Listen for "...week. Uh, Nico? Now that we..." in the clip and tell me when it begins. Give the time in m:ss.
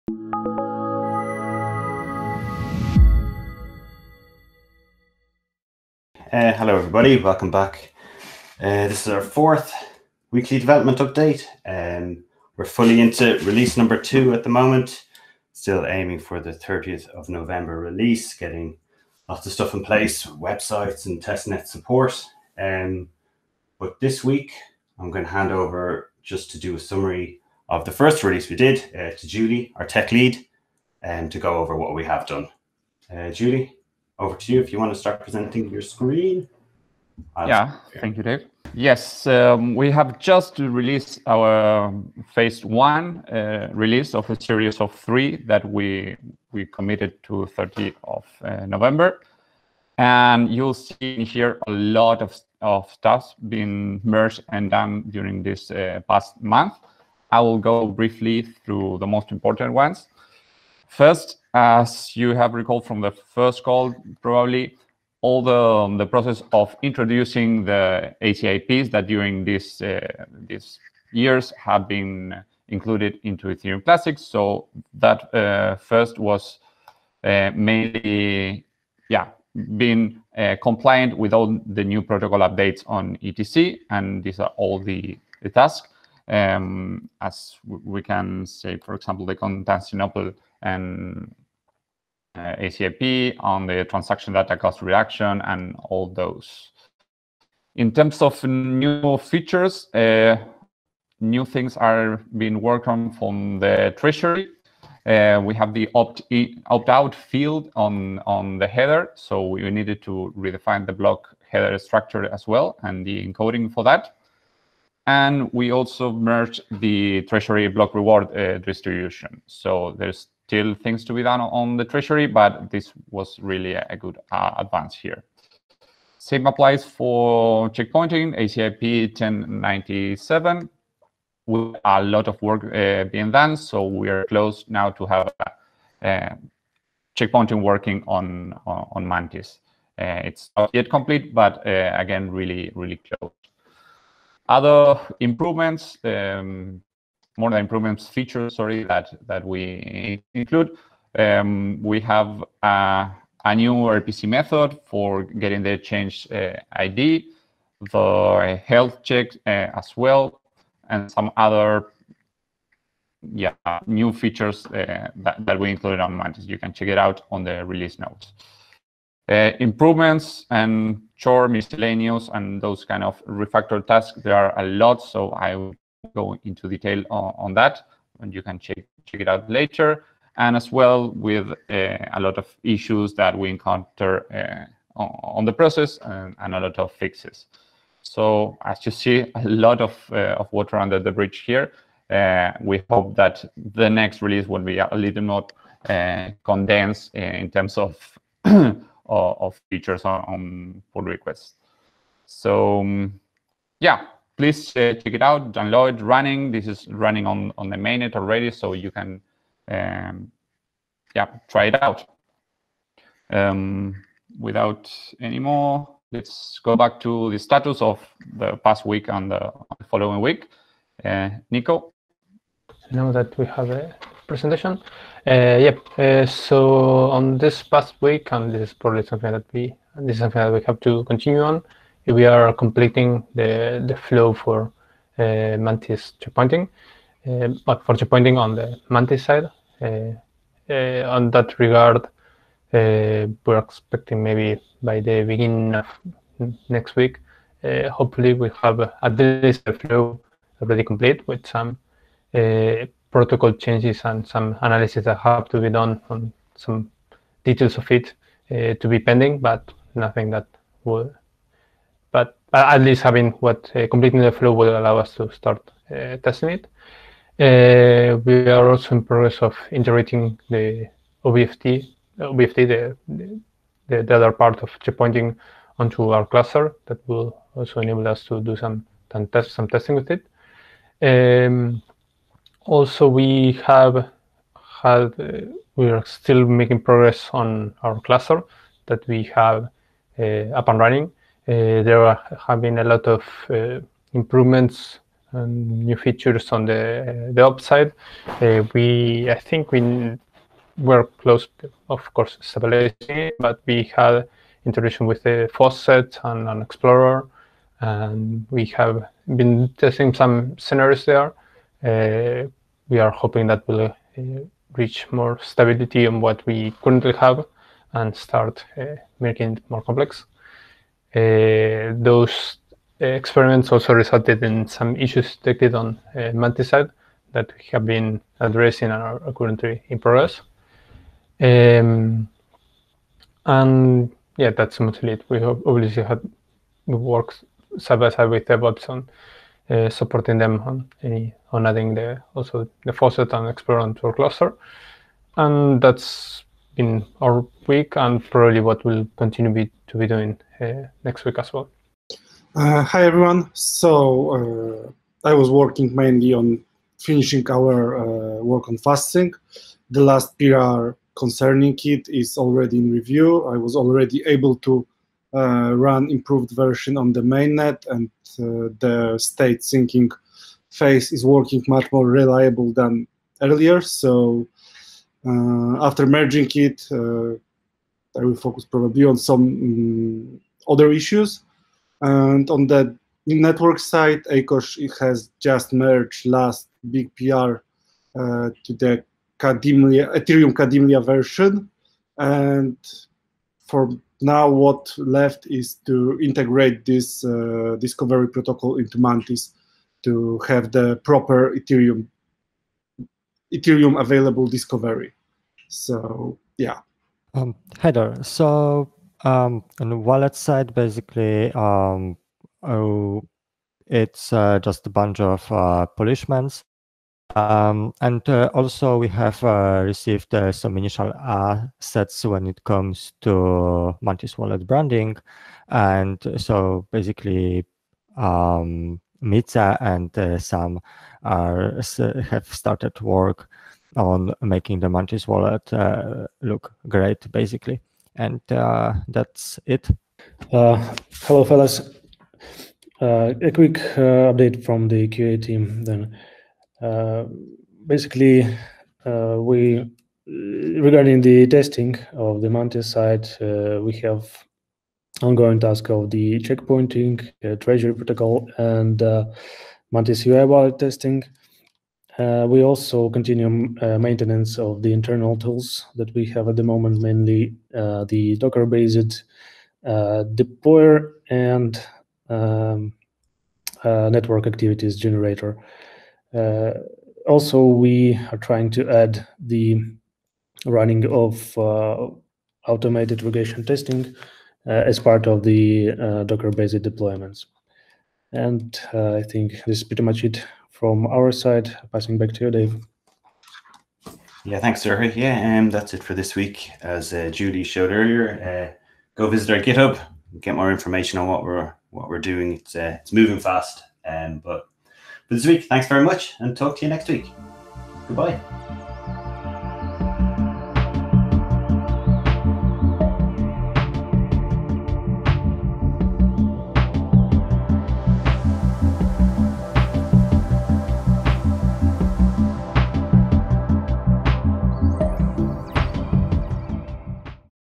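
3:40.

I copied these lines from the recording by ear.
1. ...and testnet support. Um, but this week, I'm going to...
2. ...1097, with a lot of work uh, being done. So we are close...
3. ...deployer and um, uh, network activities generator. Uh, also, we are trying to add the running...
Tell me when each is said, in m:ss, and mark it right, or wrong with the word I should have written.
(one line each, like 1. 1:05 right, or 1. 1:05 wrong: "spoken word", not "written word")
1. 0:21 right
2. 2:09 right
3. 7:50 right.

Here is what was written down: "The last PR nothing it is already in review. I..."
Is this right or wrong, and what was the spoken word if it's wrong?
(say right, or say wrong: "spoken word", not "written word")
wrong: "concerning", not "nothing".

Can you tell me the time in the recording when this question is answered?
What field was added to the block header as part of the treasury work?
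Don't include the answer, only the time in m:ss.
1:46.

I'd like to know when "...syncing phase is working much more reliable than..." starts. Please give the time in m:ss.
6:09.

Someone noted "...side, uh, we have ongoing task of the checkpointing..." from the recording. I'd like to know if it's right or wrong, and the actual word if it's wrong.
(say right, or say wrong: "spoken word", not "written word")
right.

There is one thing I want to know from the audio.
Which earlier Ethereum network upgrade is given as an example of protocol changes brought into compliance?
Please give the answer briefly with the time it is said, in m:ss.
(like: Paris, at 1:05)
Constantinople, at 1:29.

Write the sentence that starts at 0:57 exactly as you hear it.
I will go briefly through the most important ones.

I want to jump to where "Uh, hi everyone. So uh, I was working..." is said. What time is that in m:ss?
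5:52.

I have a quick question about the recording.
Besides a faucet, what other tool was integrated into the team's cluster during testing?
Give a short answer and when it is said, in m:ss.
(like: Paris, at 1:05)
an explorer, at 5:06.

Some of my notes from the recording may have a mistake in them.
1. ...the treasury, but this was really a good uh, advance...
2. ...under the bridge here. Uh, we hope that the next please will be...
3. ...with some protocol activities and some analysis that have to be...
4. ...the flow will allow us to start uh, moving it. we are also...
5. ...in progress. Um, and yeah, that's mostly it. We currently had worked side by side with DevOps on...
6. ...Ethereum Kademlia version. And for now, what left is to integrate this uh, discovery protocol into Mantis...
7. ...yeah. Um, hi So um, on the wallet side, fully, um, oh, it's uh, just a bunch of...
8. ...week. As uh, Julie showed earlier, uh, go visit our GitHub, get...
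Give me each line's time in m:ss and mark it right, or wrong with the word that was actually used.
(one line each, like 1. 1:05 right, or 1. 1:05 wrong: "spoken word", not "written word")
1. 2:01 right
2. 3:10 wrong: "release", not "please"
3. 4:11 wrong: "changes", not "activities"
4. 4:24 wrong: "testing", not "moving"
5. 5:29 wrong: "obviously", not "currently"
6. 6:30 right
7. 6:46 wrong: "basically", not "fully"
8. 8:16 right.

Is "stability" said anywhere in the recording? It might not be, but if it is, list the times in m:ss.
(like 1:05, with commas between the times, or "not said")
5:02, 5:15.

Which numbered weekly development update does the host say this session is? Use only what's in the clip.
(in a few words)
fourth.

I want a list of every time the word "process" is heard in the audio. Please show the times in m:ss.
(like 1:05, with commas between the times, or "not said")
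1:06, 3:05.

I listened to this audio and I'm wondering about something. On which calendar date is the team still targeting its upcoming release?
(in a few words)
30th of November.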